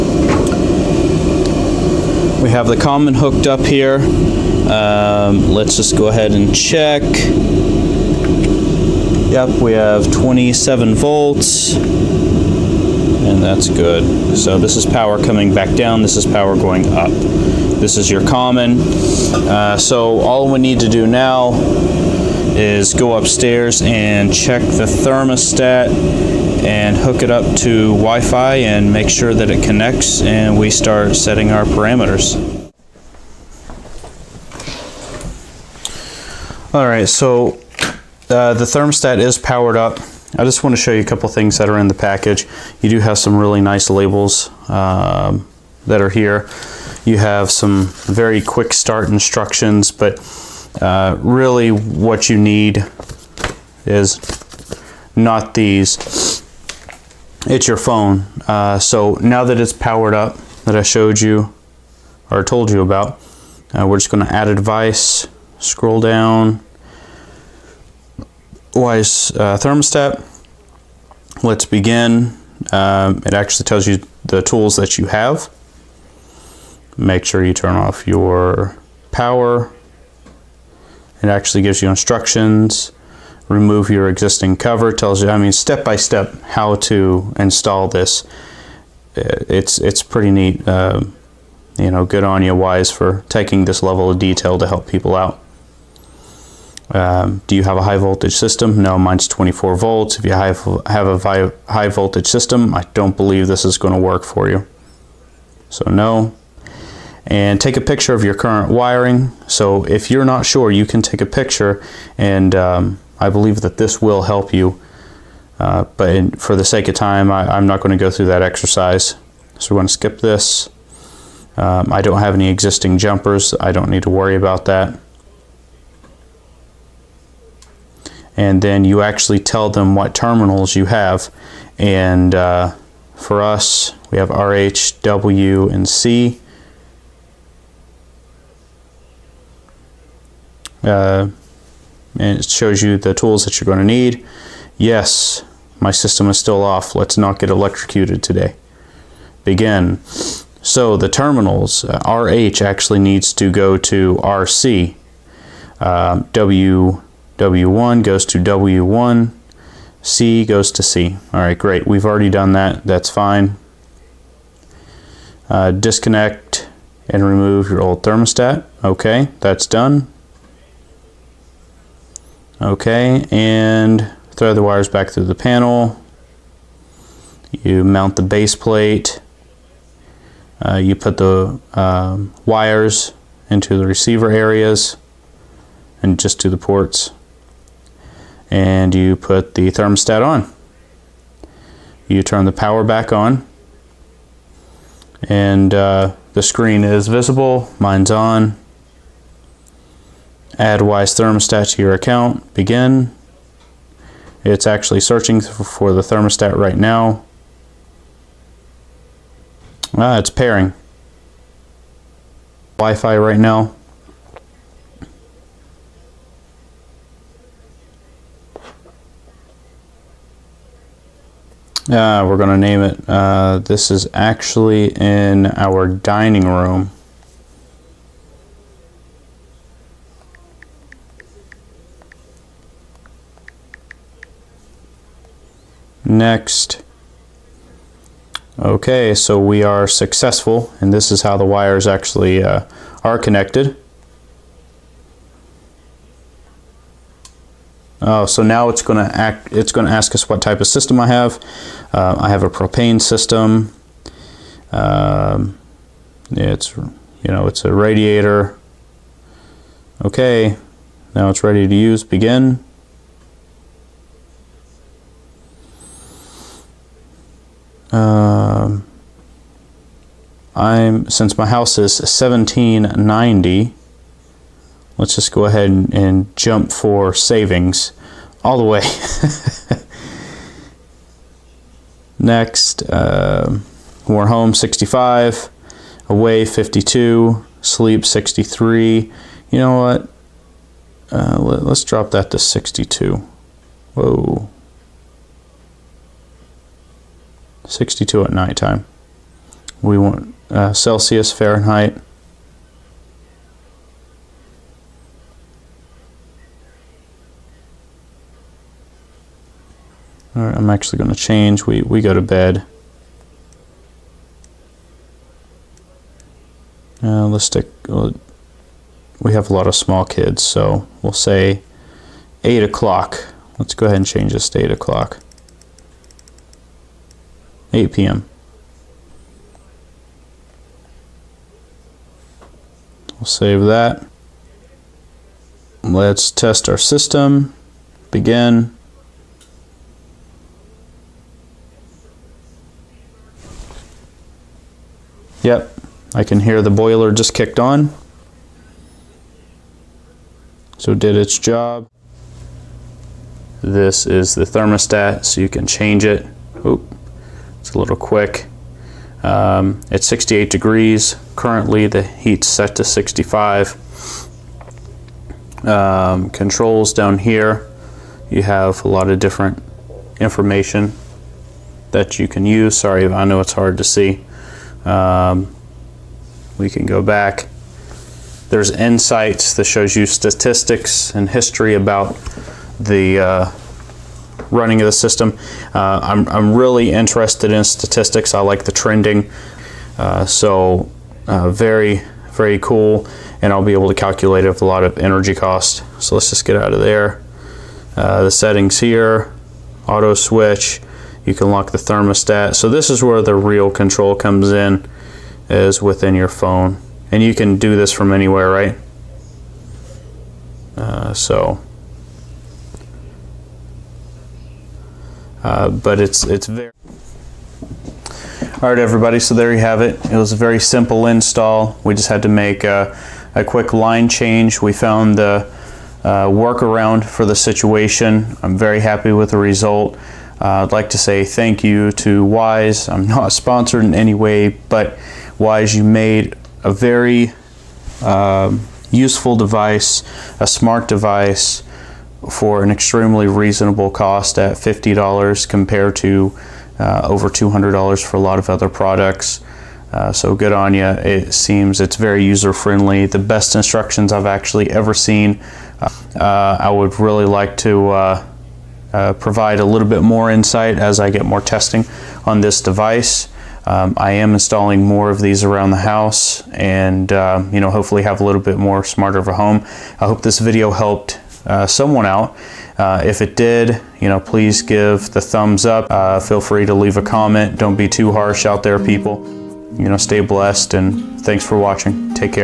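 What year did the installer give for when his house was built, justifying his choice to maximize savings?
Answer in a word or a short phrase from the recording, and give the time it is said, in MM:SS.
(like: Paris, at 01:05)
1790, at 04:31.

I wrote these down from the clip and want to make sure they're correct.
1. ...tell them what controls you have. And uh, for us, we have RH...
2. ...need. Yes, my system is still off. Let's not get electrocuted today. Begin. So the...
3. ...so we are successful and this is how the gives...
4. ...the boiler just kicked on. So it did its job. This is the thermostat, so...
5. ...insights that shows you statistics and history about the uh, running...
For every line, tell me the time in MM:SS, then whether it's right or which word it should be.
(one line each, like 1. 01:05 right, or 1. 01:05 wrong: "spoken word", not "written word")
1. 02:09 wrong: "terminals", not "controls"
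2. 02:23 right
3. 03:59 wrong: "wires", not "gives"
4. 05:46 right
5. 06:18 right.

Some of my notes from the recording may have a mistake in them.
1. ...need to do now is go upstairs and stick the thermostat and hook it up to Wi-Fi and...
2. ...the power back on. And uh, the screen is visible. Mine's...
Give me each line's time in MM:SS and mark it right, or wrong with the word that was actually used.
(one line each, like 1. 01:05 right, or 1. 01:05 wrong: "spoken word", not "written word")
1. 00:20 wrong: "check", not "stick"
2. 03:12 right.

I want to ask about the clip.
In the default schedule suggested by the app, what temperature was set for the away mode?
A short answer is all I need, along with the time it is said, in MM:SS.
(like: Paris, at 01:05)
52, at 04:46.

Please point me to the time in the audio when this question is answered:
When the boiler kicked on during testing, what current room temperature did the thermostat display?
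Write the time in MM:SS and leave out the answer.
06:00.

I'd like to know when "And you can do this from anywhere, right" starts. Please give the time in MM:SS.
06:47.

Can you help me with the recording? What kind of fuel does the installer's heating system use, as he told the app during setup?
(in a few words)
propane.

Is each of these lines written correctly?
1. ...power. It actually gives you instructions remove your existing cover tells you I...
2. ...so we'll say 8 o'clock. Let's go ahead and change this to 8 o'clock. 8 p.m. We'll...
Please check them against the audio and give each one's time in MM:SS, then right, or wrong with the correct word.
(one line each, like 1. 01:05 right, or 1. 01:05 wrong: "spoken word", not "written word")
1. 01:19 right
2. 05:20 right.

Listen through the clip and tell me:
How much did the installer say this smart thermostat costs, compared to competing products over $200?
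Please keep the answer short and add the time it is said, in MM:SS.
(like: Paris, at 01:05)
$50, at 07:24.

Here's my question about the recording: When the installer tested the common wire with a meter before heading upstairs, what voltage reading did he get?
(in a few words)
27 volts.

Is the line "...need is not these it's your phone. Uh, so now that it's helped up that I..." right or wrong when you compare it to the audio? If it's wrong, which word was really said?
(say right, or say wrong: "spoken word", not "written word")
wrong: "powered", not "helped".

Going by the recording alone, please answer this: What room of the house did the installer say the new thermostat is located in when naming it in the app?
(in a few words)
dining room.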